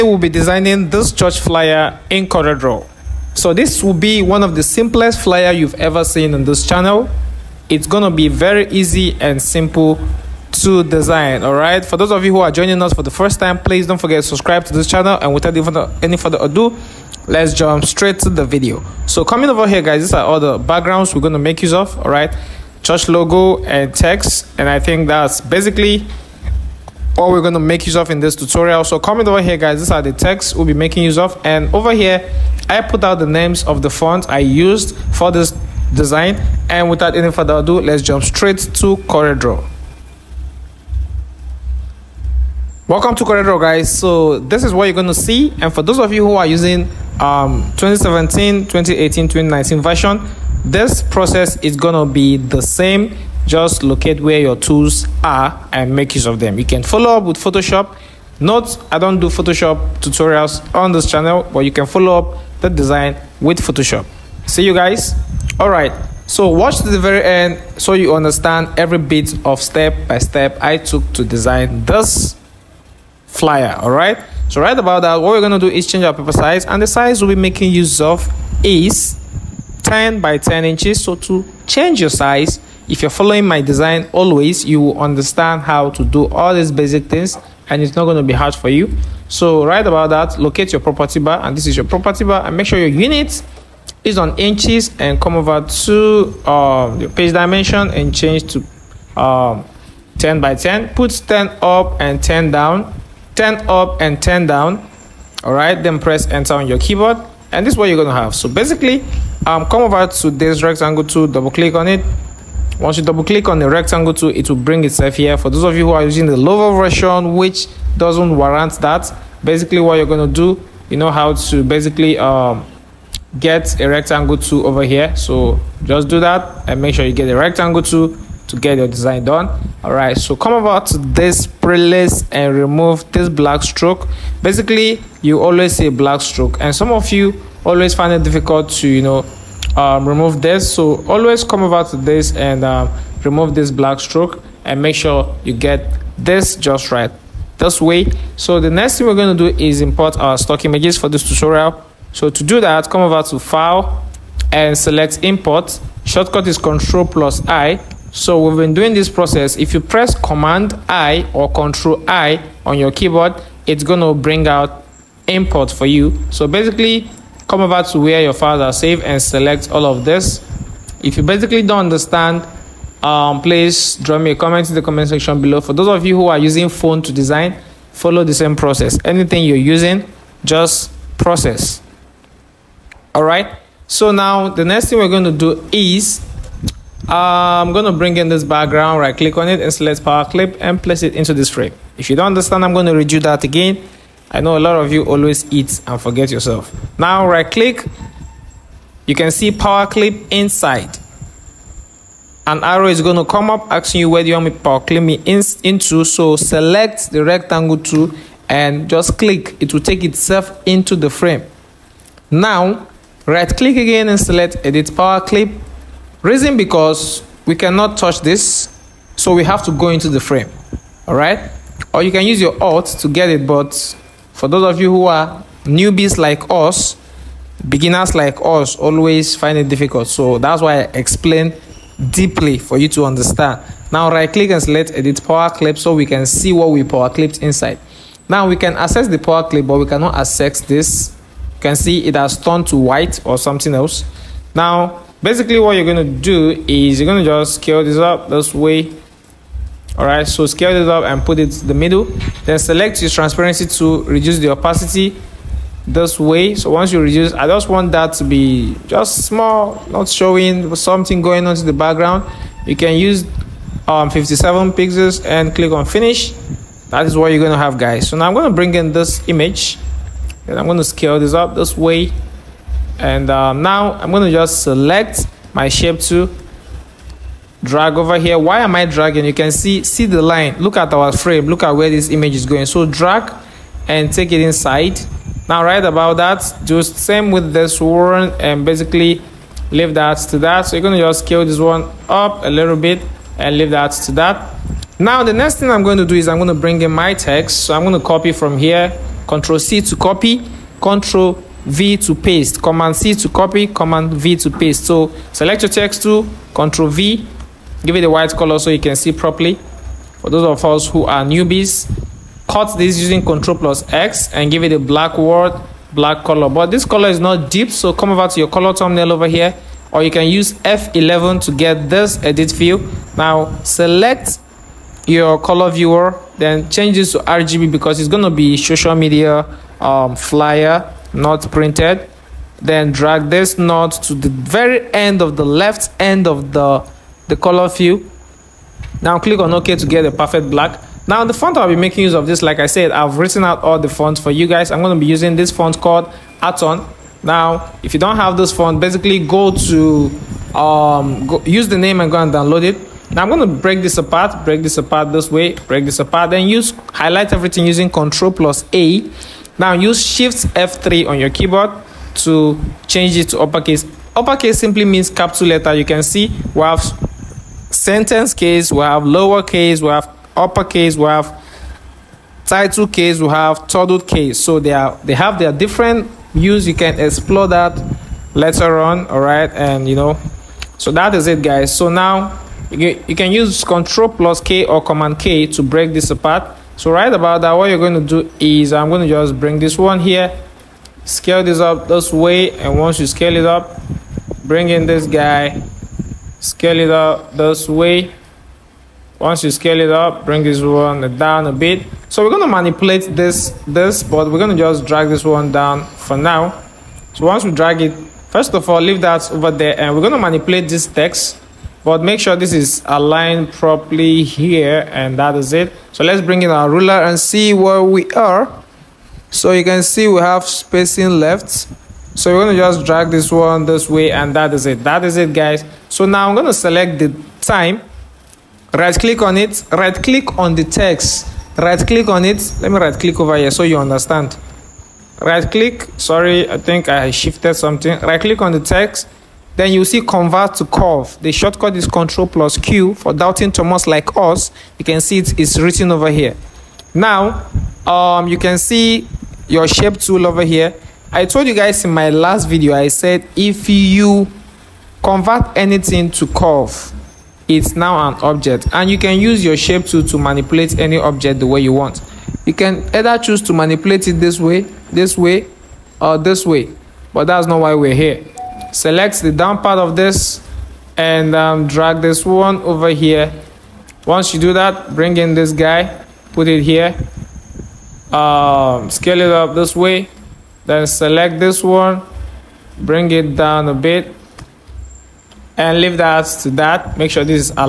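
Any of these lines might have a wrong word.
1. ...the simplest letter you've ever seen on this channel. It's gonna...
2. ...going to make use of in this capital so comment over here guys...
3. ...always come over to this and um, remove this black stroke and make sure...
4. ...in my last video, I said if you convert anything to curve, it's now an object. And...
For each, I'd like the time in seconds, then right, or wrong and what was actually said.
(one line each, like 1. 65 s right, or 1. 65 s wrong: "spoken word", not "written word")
1. 4 s wrong: "flyer", not "letter"
2. 27 s wrong: "tutorial", not "capital"
3. 141 s right
4. 451 s right.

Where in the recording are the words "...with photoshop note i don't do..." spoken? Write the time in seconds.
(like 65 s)
57 s.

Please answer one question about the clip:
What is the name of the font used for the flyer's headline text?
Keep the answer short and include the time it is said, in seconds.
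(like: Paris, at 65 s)
Anton, at 346 s.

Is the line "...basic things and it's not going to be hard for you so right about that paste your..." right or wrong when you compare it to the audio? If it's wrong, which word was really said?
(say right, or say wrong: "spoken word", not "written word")
wrong: "locate", not "paste".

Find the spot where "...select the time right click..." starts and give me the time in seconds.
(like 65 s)
426 s.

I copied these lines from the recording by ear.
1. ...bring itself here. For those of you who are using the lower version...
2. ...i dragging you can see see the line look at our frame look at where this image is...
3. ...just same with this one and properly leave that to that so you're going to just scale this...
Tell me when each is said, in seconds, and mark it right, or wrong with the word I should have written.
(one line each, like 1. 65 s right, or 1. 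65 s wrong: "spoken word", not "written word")
1. 114 s right
2. 278 s right
3. 286 s wrong: "basically", not "properly".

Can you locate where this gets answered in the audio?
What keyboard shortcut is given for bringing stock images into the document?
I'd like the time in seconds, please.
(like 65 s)
156 s.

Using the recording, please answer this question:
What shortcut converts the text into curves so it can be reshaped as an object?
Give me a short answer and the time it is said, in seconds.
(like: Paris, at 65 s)
Control plus Q, at 441 s.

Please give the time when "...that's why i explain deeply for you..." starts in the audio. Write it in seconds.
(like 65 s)
230 s.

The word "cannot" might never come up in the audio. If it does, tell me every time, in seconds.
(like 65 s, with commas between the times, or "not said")
217 s, 239 s.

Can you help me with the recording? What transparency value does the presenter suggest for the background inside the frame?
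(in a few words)
57 pixels.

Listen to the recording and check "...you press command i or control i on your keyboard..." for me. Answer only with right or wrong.
right.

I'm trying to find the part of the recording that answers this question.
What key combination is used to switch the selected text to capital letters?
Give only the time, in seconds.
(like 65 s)
360 s.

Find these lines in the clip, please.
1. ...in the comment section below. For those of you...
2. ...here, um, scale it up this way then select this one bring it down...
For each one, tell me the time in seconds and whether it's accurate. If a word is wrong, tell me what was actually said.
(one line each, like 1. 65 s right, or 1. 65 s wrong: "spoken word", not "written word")
1. 174 s right
2. 476 s right.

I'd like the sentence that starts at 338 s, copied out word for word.
Now click on OK to get the perfect black.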